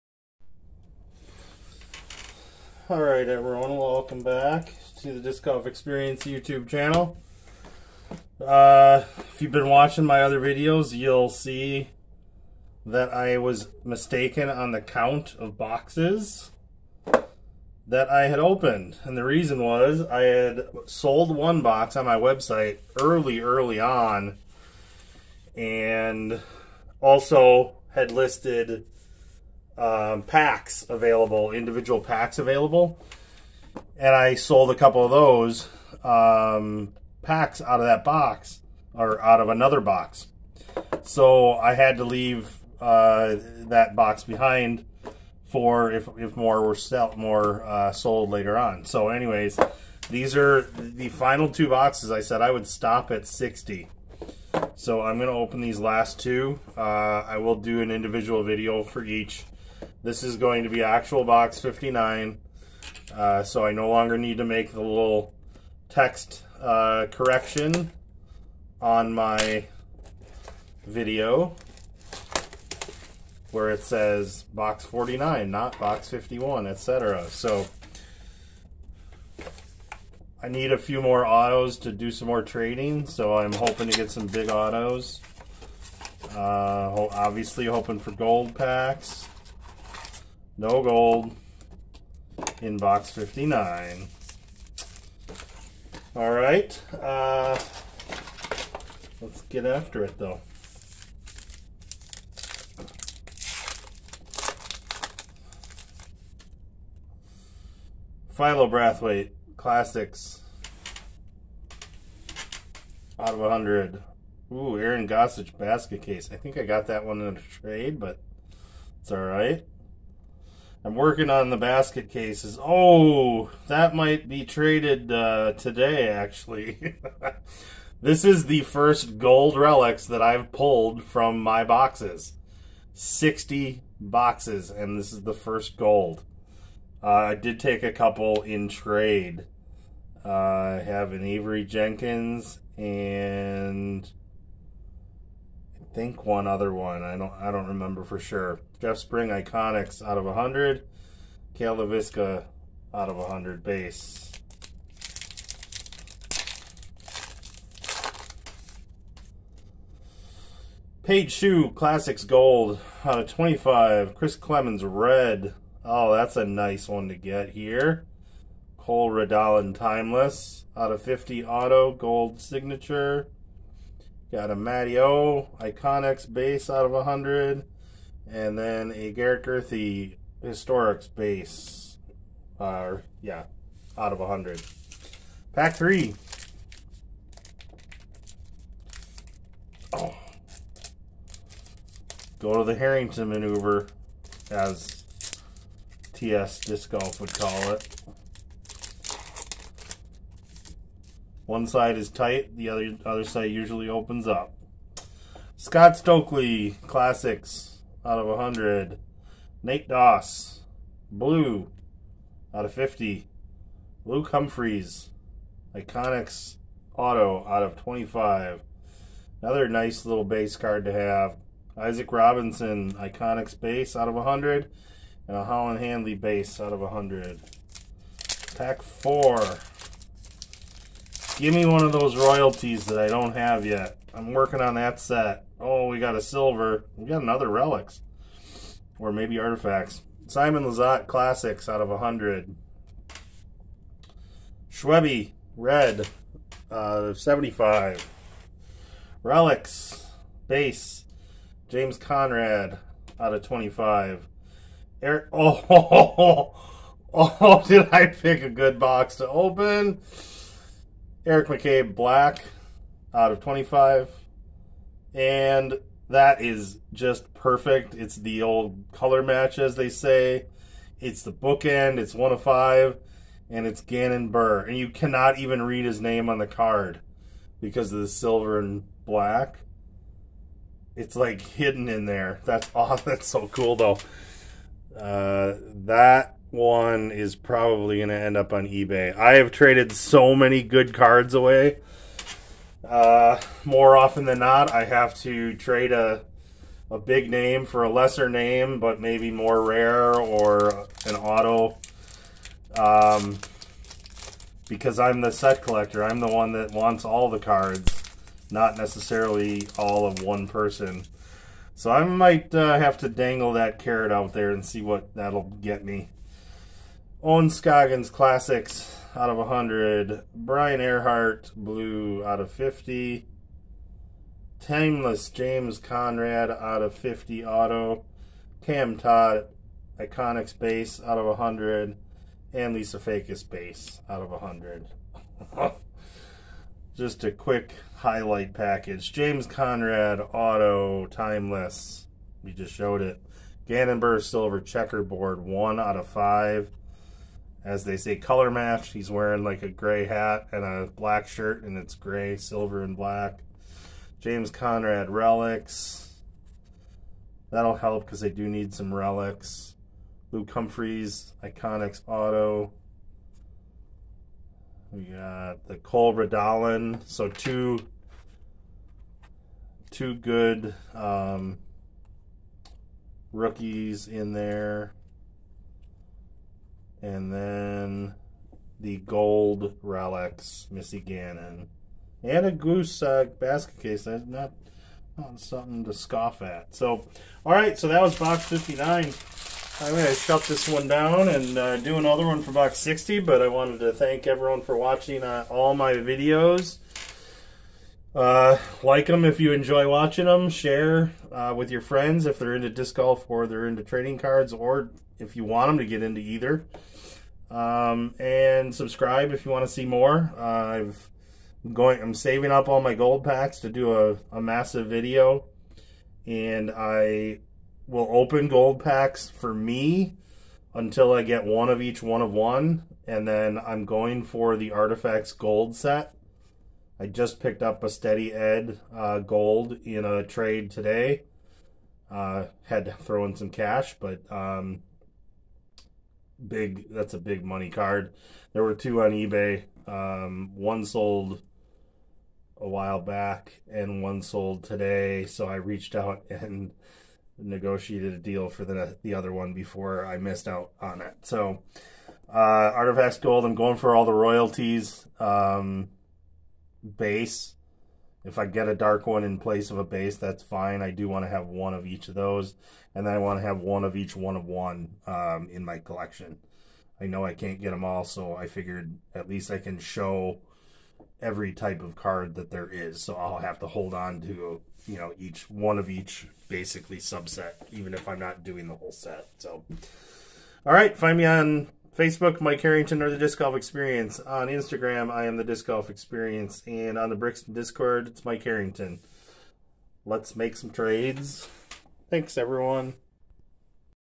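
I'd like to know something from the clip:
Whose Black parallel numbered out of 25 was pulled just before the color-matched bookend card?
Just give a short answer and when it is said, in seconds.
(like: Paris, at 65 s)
Eric McCabe, at 261 s.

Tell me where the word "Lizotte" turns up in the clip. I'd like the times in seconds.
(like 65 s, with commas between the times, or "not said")
240 s.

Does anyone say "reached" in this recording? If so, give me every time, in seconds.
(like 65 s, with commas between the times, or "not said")
445 s.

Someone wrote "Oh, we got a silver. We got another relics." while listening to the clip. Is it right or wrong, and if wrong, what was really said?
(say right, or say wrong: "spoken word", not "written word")
right.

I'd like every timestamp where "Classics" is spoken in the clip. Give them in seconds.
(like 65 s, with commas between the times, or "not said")
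109 s, 161 s, 206 s, 241 s, 318 s.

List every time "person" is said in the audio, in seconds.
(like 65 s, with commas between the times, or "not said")
310 s.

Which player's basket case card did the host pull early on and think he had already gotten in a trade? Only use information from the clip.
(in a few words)
Aaron Gossage.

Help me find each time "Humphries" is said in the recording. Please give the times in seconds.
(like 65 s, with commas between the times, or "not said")
214 s, 360 s.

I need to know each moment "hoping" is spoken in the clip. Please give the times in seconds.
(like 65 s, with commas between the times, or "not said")
83 s, 87 s.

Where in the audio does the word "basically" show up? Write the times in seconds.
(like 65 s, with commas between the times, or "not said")
476 s.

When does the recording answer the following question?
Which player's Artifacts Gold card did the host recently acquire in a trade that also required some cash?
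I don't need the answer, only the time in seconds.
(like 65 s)
427 s.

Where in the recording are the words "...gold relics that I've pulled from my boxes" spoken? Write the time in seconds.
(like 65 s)
129 s.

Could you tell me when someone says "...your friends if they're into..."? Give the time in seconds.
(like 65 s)
401 s.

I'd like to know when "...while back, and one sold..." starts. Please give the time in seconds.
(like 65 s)
442 s.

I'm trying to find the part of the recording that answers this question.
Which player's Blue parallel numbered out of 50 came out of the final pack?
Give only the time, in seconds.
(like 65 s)
320 s.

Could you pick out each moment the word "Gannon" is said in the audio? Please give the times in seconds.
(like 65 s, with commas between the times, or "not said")
273 s, 343 s, 380 s.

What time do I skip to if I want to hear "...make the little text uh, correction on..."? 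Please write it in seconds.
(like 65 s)
64 s.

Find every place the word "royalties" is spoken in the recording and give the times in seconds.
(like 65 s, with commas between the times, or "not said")
232 s, 454 s.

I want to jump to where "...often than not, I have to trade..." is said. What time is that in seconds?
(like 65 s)
293 s.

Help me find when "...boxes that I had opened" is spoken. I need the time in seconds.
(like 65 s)
15 s.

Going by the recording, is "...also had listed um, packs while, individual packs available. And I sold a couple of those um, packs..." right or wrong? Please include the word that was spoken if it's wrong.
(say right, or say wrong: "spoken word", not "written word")
wrong: "available", not "while".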